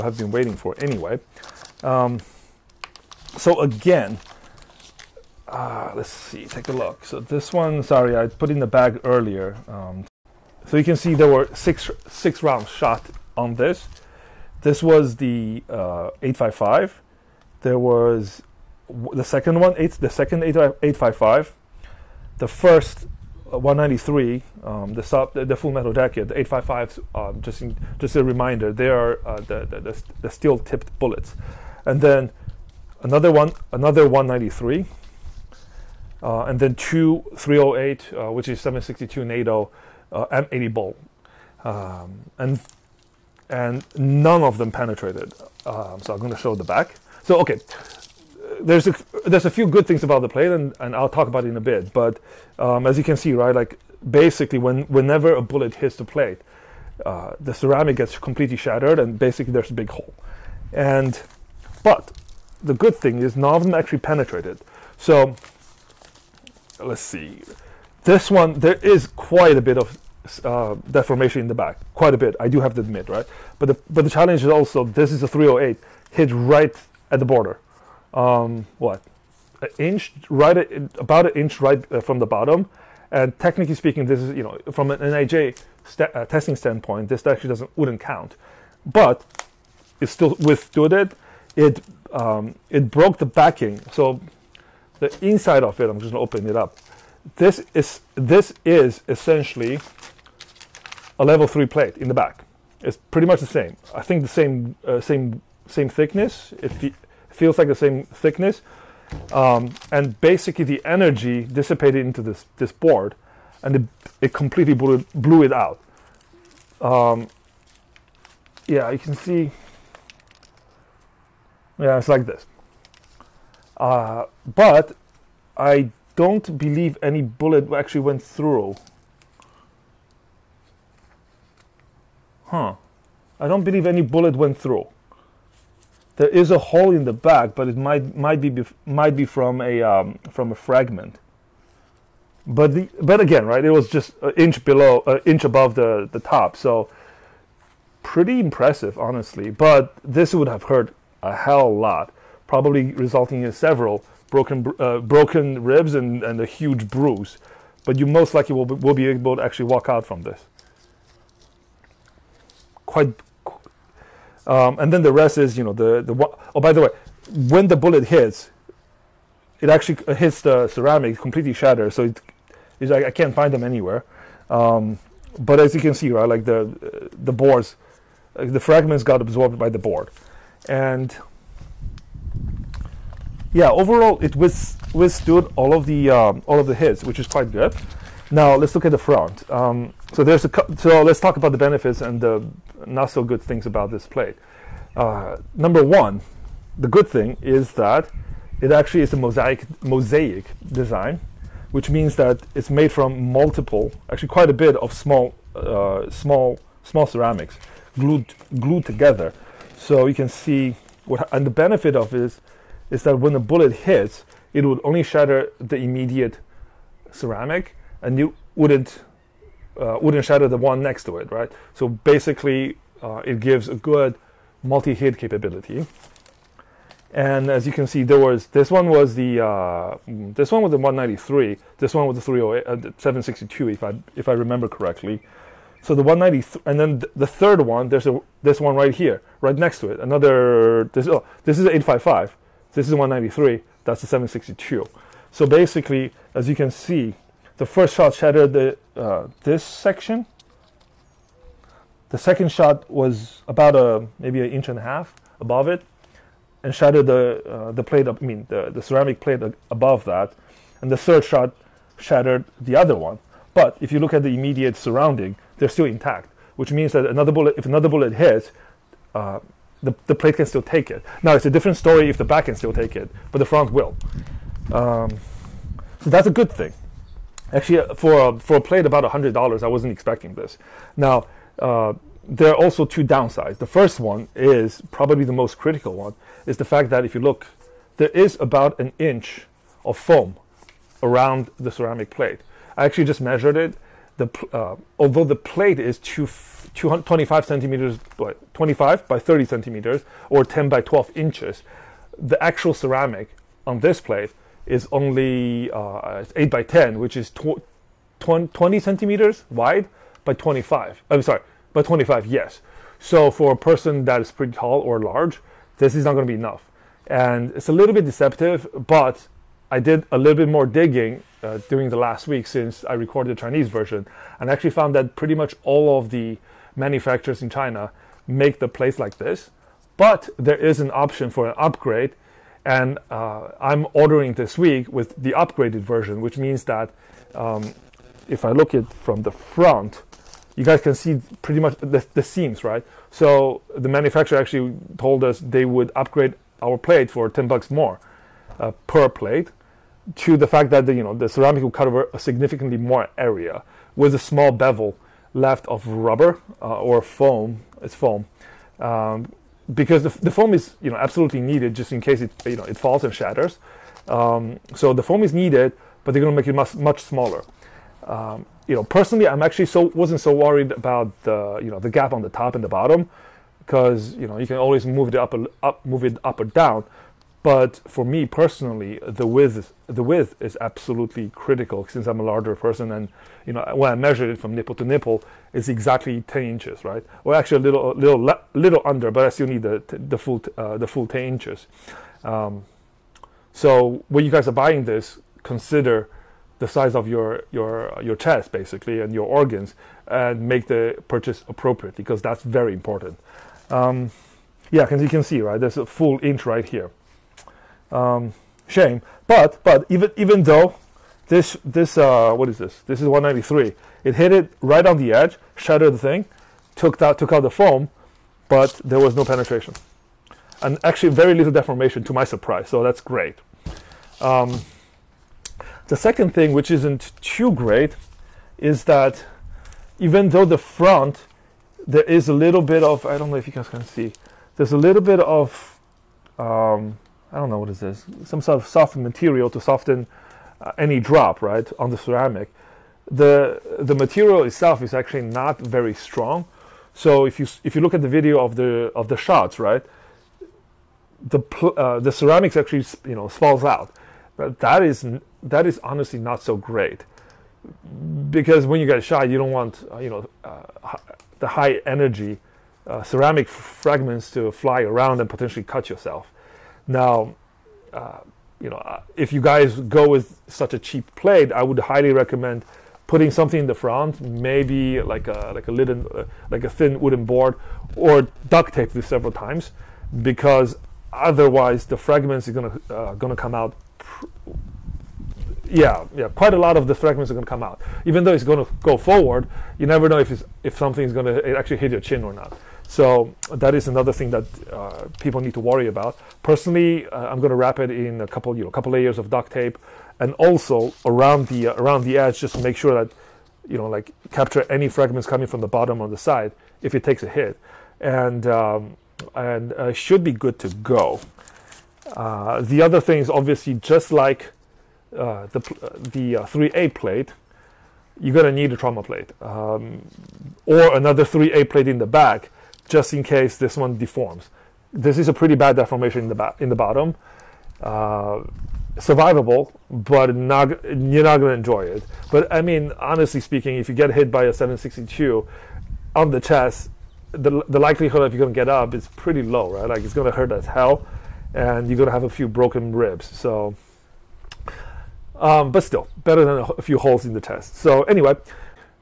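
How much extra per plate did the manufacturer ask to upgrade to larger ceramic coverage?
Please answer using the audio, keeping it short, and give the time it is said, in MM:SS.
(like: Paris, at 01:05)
10 bucks, at 05:47.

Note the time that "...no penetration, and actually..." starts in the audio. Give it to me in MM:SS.
06:59.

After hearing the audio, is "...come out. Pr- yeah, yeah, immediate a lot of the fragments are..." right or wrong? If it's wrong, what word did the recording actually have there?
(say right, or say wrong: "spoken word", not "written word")
wrong: "quite", not "immediate".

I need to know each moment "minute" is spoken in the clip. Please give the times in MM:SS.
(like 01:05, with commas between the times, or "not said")
not said.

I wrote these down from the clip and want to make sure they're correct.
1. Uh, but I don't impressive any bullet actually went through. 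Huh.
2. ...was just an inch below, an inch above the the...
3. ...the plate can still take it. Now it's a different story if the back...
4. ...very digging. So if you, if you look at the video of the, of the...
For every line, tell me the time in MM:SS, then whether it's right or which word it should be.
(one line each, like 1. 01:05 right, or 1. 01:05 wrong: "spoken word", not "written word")
1. 02:03 wrong: "believe", not "impressive"
2. 02:23 right
3. 04:30 right
4. 07:25 wrong: "strong", not "digging".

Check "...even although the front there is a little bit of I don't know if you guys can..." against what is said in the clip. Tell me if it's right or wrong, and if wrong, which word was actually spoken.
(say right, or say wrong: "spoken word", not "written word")
wrong: "though", not "although".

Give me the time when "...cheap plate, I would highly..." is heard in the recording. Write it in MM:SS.
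07:50.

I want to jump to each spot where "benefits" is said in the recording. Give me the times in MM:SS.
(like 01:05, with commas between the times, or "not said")
03:11, 03:31.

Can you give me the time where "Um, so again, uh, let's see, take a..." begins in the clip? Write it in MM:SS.
00:01.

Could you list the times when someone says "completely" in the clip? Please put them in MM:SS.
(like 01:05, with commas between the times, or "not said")
00:58, 01:54, 02:51.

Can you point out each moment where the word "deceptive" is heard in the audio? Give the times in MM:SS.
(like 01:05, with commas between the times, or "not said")
05:18.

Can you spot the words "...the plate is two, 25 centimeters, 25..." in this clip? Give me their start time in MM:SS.
04:55.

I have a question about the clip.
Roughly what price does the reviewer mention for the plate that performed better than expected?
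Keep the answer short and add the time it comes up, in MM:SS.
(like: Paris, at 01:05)
$100, at 04:39.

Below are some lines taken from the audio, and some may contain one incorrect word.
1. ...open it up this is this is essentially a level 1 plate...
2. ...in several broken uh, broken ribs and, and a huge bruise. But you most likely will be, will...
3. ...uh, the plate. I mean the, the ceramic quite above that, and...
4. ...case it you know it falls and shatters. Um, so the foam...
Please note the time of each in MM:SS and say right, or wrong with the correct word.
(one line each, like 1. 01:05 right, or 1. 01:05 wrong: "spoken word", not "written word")
1. 01:36 wrong: "3", not "1"
2. 02:33 right
3. 04:17 wrong: "plate", not "quite"
4. 06:02 right.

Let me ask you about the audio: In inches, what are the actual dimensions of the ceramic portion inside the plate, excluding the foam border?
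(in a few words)
8 by 10.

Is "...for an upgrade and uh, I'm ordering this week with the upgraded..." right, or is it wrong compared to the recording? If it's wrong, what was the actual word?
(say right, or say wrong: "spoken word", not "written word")
right.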